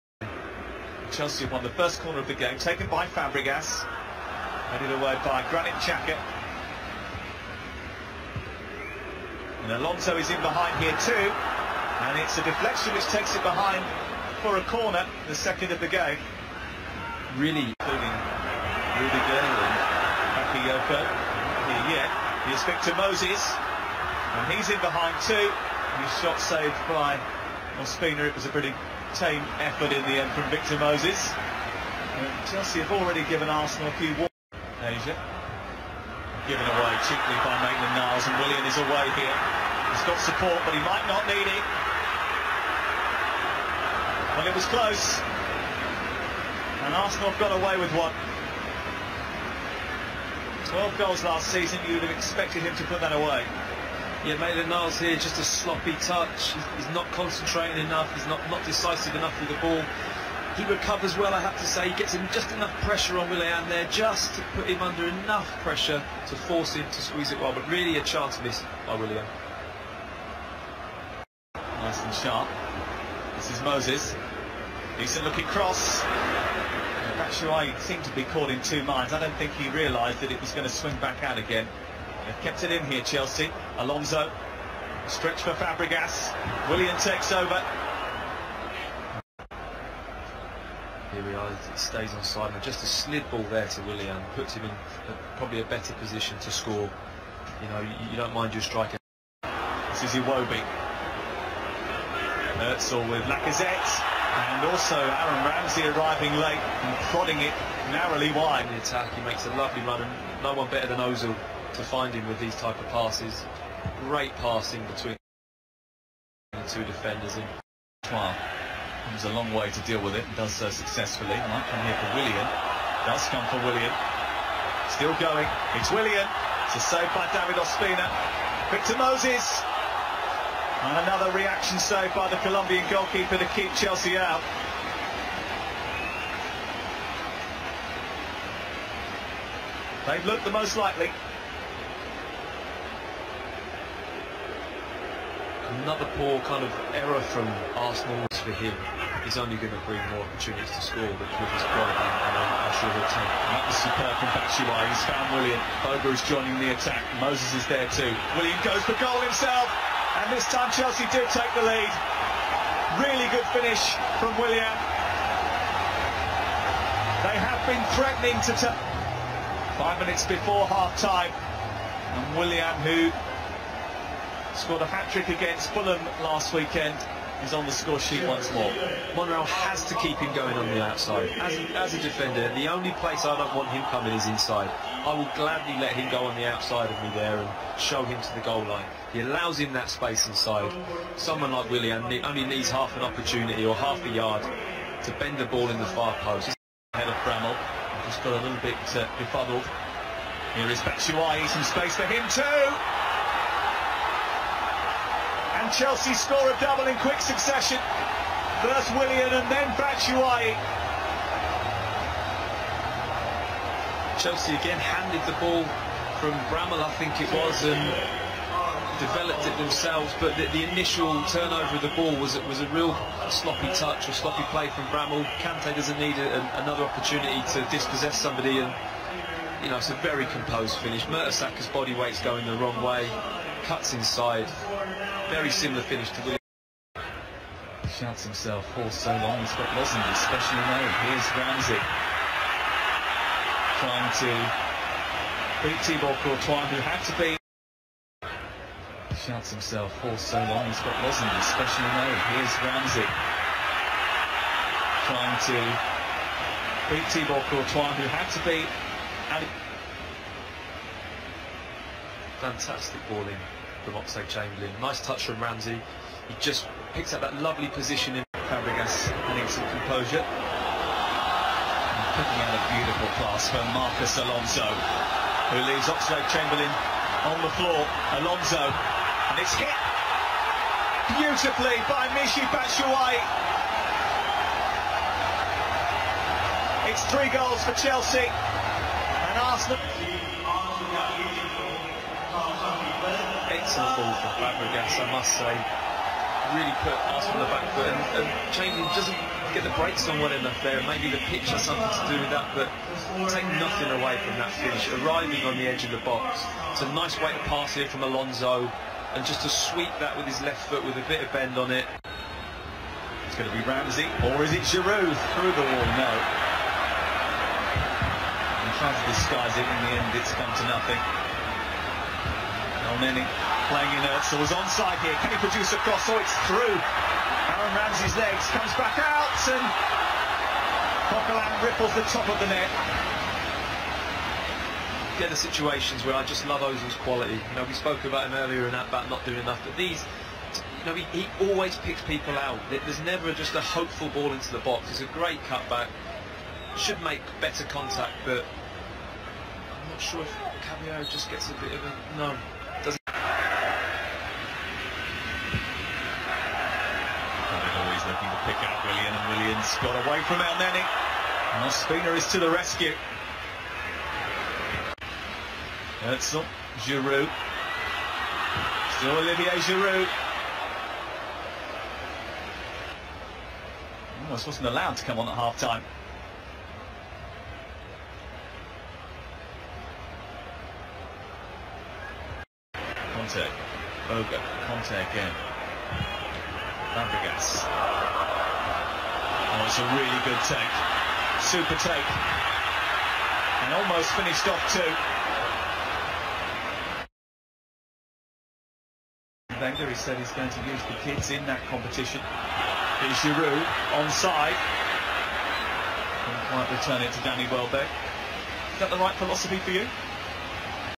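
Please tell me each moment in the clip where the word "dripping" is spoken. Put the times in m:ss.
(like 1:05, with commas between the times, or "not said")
not said.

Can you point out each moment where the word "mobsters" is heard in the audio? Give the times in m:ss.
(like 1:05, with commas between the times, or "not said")
not said.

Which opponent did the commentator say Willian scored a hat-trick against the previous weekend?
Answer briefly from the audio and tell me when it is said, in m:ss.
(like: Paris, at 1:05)
Fulham, at 2:55.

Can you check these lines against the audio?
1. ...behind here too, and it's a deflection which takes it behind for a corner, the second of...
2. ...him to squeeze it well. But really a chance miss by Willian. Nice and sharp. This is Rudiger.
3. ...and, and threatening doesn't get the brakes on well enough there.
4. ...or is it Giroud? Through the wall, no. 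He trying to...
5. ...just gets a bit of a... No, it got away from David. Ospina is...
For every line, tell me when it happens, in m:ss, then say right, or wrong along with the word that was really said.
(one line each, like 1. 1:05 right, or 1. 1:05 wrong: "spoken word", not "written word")
1. 0:10 right
2. 1:06 wrong: "Moses", not "Rudiger"
3. 4:57 wrong: "changing", not "threatening"
4. 5:14 right
5. 5:51 wrong: "Elneny", not "David".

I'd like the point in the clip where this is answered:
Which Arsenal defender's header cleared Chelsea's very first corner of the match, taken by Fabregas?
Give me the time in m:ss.
0:05.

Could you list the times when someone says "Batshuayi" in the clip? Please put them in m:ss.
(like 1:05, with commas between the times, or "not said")
1:17, 2:34, 3:20, 3:29, 4:42.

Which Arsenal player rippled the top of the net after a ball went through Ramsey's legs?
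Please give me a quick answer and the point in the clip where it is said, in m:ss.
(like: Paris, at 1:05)
Coquelin, at 5:31.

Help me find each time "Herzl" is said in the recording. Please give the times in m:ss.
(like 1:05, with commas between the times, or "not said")
1:42, 6:06.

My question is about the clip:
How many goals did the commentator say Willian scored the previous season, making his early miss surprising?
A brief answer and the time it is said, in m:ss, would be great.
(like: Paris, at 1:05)
12, at 0:50.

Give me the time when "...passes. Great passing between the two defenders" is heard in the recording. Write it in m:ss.
1:52.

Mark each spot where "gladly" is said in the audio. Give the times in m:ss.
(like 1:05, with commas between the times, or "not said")
3:05.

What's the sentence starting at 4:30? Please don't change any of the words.
And putting out a beautiful pass from Marcos Alonso, who leaves Oxlade Chamberlain on the floor.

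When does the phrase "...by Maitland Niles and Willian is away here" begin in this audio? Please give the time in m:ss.
0:37.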